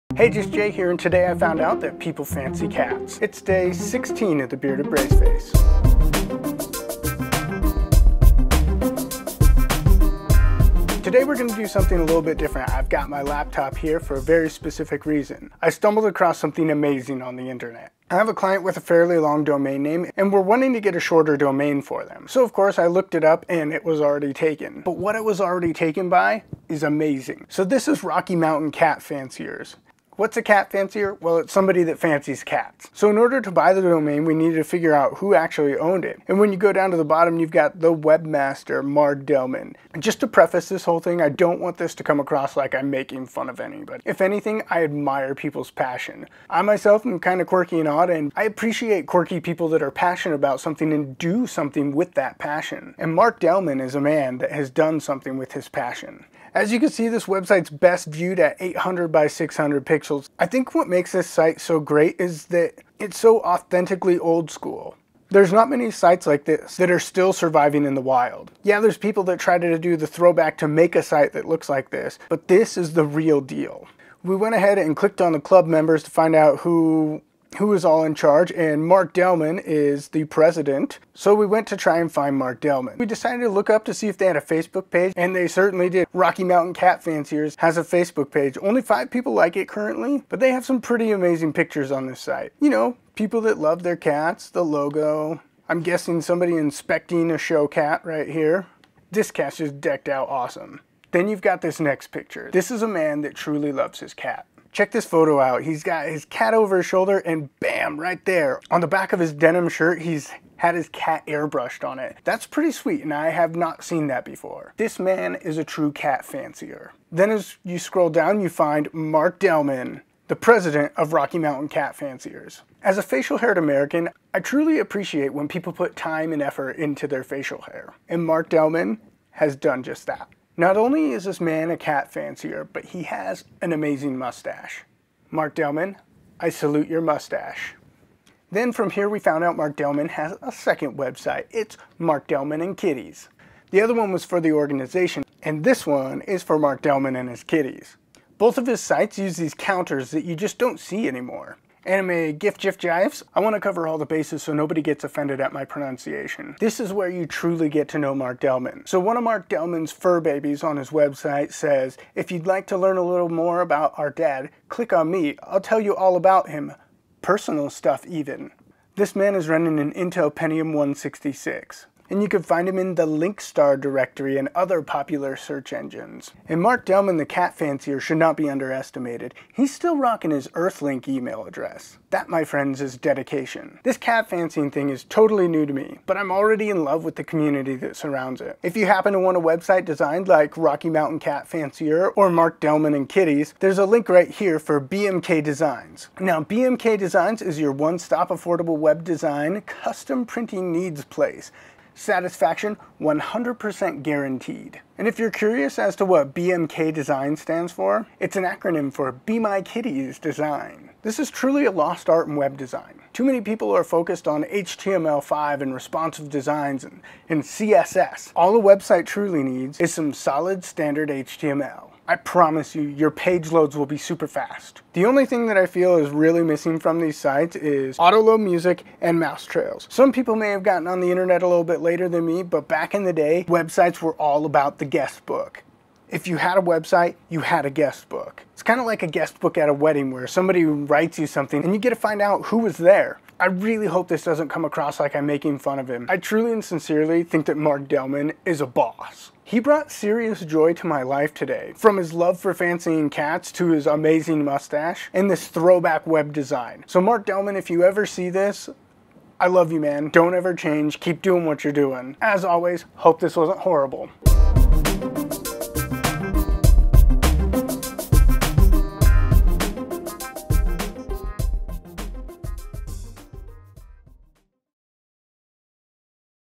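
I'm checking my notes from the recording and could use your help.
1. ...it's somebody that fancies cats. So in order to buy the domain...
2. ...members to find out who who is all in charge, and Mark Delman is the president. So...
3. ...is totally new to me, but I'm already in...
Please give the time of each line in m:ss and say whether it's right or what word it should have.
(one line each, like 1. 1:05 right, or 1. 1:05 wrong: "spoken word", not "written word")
1. 0:31 right
2. 1:15 right
3. 3:04 right.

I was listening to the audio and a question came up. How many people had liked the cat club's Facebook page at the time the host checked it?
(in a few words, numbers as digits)
5.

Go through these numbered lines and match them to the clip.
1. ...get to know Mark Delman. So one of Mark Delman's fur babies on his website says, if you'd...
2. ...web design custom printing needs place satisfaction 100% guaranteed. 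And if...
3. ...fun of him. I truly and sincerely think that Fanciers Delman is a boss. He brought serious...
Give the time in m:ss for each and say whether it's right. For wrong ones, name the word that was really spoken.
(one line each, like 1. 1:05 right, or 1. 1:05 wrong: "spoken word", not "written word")
1. 2:37 right
2. 3:18 right
3. 4:05 wrong: "Mark", not "Fanciers".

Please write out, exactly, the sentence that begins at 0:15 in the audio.
I stumbled across something amazing on the internet.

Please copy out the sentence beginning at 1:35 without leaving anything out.
I'm guessing somebody inspecting a show cat right here.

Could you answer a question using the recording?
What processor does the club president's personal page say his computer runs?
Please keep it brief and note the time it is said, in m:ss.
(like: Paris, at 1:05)
Intel Pentium 166, at 2:49.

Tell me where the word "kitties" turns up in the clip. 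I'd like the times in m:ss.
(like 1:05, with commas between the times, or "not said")
2:22, 2:27, 3:13, 3:29.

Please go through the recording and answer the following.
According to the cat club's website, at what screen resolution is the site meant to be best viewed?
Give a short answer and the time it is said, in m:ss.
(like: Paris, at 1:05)
800 by 600 pixels, at 0:58.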